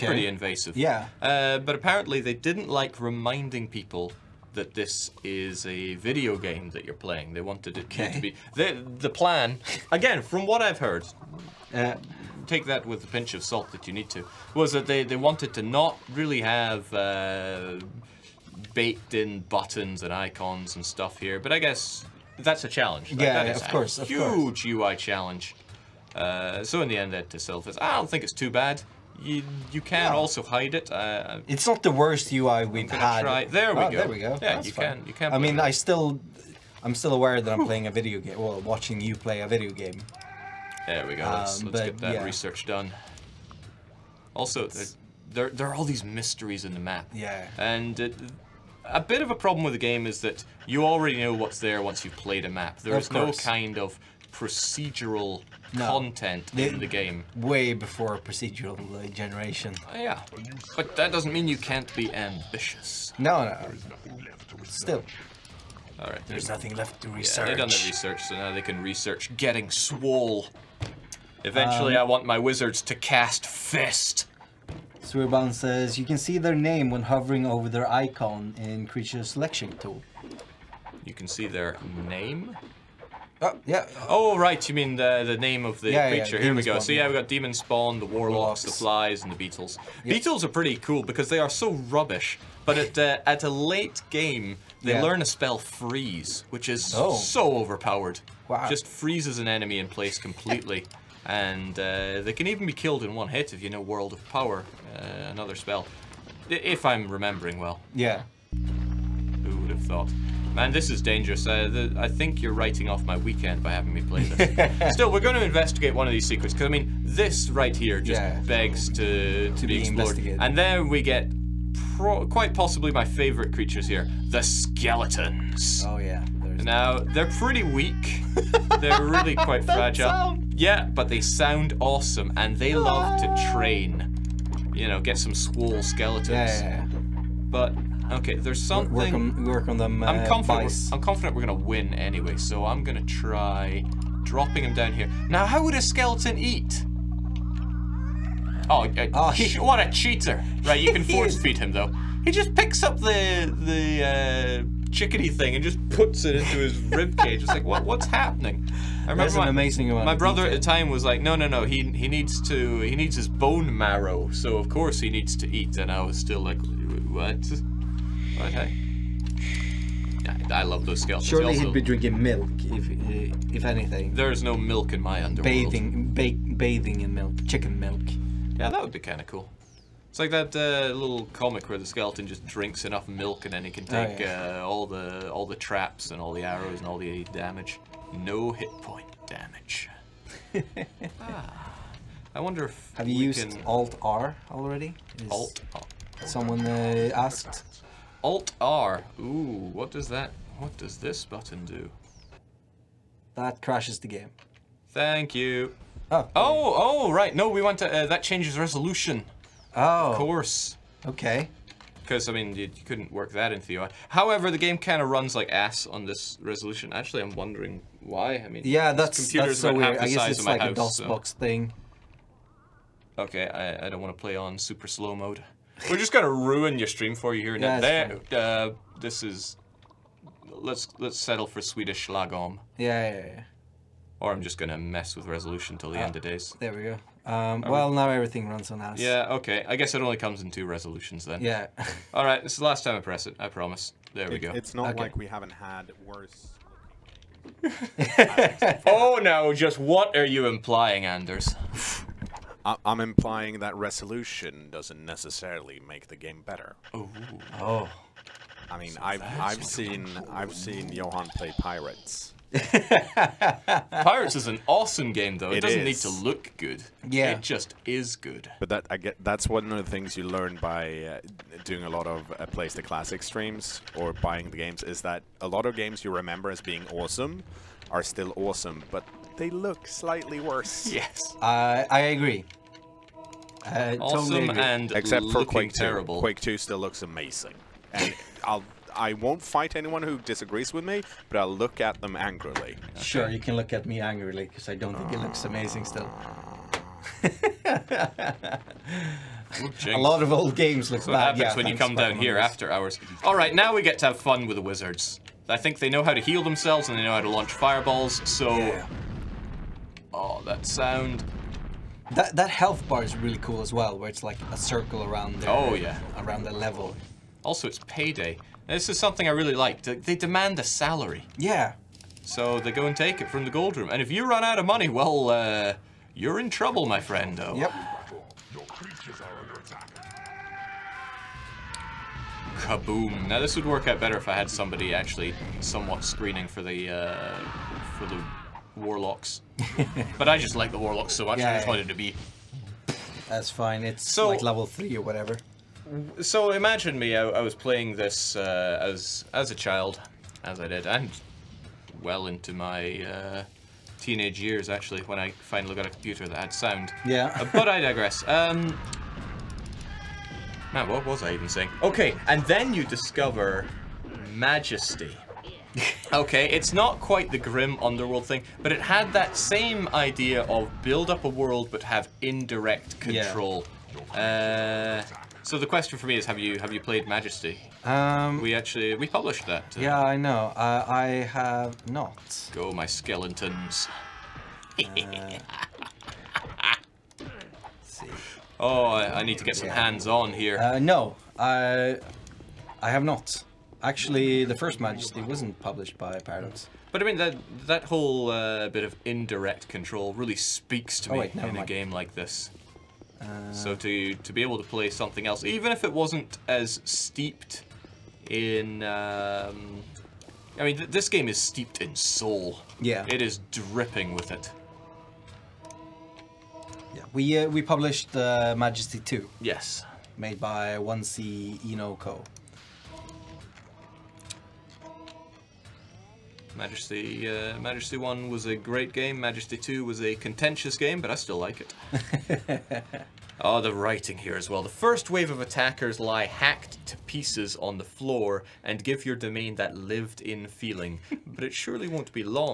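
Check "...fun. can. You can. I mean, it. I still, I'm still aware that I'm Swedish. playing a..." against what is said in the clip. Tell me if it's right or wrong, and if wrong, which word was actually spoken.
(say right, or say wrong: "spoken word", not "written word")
wrong: "Whew", not "Swedish".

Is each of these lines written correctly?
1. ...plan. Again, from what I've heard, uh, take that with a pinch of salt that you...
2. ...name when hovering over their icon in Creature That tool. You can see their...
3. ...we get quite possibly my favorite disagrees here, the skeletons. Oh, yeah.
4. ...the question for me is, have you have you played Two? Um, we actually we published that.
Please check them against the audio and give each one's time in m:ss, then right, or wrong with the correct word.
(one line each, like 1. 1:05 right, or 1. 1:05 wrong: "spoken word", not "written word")
1. 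0:09 right
2. 1:16 wrong: "Selection", not "That"
3. 2:00 wrong: "creatures", not "disagrees"
4. 6:15 wrong: "Majesty", not "Two".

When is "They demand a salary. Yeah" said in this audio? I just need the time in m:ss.
5:19.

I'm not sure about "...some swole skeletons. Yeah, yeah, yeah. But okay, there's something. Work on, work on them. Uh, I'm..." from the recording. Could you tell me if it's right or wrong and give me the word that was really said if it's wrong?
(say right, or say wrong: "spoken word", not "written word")
right.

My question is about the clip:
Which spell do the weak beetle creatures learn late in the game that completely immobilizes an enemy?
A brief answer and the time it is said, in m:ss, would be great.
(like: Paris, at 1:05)
Freeze, at 1:35.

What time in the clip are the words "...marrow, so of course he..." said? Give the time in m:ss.
2:43.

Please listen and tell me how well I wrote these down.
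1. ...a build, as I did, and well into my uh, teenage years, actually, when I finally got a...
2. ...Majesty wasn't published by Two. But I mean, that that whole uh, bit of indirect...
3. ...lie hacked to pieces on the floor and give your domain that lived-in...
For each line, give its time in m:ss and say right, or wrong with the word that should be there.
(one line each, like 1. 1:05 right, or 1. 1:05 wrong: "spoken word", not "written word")
1. 5:49 wrong: "child", not "build"
2. 6:34 wrong: "Paradox", not "Two"
3. 7:15 right.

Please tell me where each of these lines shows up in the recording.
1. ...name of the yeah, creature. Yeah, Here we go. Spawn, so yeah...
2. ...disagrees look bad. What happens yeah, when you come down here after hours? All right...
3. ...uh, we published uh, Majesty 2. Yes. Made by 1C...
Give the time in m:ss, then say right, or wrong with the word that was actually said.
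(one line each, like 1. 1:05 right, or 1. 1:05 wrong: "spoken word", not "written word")
1. 1:25 right
2. 5:00 wrong: "games", not "disagrees"
3. 6:57 right.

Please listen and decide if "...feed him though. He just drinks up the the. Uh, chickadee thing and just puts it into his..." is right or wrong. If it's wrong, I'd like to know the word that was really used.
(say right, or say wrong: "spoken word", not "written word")
wrong: "picks", not "drinks".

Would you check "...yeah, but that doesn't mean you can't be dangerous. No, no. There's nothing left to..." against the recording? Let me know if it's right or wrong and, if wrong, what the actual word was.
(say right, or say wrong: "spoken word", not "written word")
wrong: "ambitious", not "dangerous".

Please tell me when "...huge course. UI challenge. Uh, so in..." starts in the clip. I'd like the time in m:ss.
0:23.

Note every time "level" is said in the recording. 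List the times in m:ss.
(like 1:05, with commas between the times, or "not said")
5:16, 5:44.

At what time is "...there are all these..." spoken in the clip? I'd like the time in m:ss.
0:45.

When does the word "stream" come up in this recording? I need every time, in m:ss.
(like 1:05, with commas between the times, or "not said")
3:46, 4:33.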